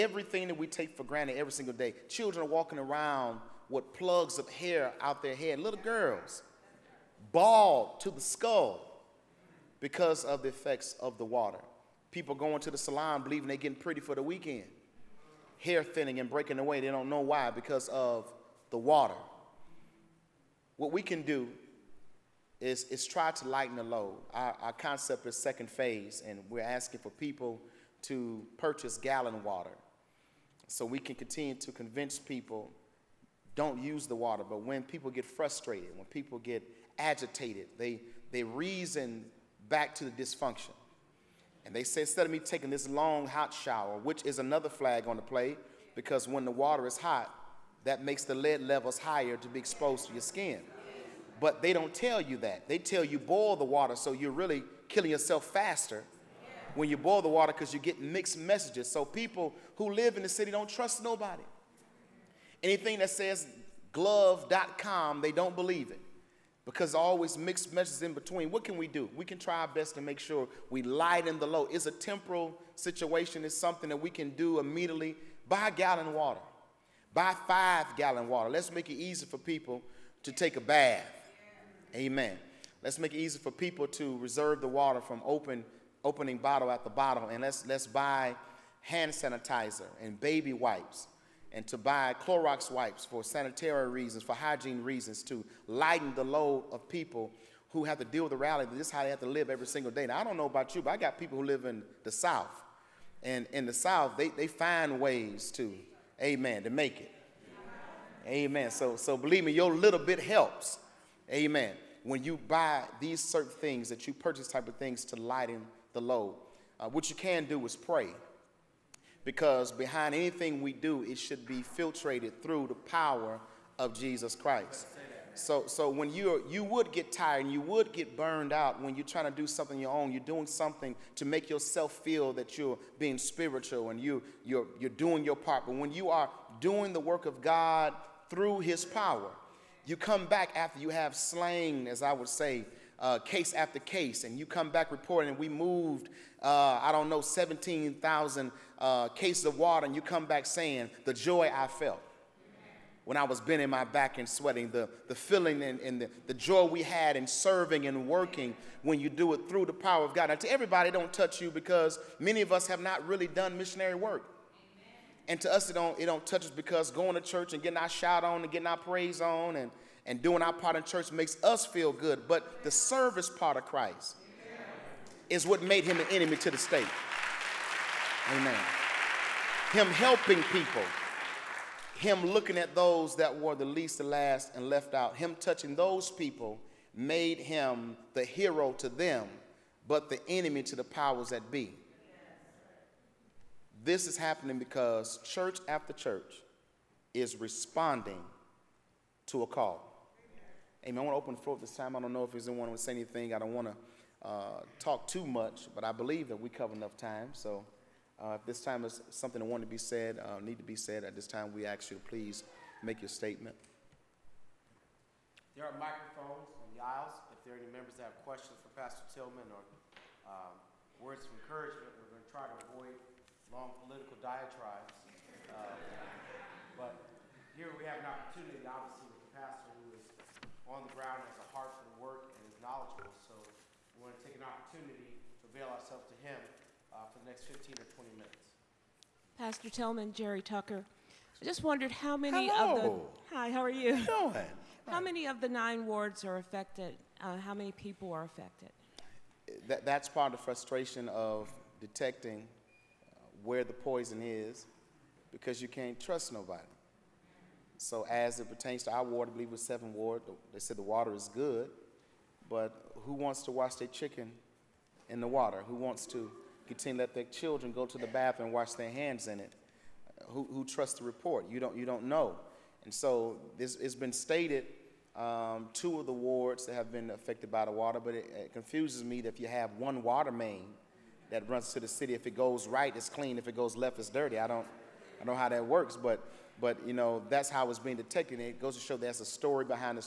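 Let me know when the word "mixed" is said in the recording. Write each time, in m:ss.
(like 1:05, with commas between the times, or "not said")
0:57, 1:07.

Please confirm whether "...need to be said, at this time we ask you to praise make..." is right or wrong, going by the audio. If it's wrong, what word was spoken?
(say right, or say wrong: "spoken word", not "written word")
wrong: "please", not "praise".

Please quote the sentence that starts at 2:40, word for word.
Now, to everybody, don't touch you because many of us have not really done missionary work.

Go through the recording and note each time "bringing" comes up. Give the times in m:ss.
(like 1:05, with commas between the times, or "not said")
not said.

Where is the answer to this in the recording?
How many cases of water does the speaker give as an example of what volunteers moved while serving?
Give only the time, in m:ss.
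2:27.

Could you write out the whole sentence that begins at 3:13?
This is happening because church after church is responding to a call.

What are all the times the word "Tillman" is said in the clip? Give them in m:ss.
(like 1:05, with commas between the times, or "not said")
3:39, 3:59.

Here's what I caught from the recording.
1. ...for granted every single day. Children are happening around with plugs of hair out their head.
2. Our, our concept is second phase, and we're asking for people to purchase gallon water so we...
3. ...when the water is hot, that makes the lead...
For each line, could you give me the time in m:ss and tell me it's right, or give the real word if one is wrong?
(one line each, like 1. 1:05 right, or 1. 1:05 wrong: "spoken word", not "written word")
1. 0:00 wrong: "walking", not "happening"
2. 0:24 right
3. 0:46 right.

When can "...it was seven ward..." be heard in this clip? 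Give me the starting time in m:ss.
4:19.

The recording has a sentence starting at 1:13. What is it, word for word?
It's something that we can do immediately.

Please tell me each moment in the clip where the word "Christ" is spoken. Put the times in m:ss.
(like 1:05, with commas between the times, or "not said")
2:04, 2:53.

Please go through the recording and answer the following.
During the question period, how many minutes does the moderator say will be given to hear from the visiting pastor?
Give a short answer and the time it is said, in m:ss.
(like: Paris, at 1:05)
15 or 20 minutes, at 3:57.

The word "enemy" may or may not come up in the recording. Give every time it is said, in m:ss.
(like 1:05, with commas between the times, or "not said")
2:56, 3:10.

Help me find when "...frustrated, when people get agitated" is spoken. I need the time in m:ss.
0:35.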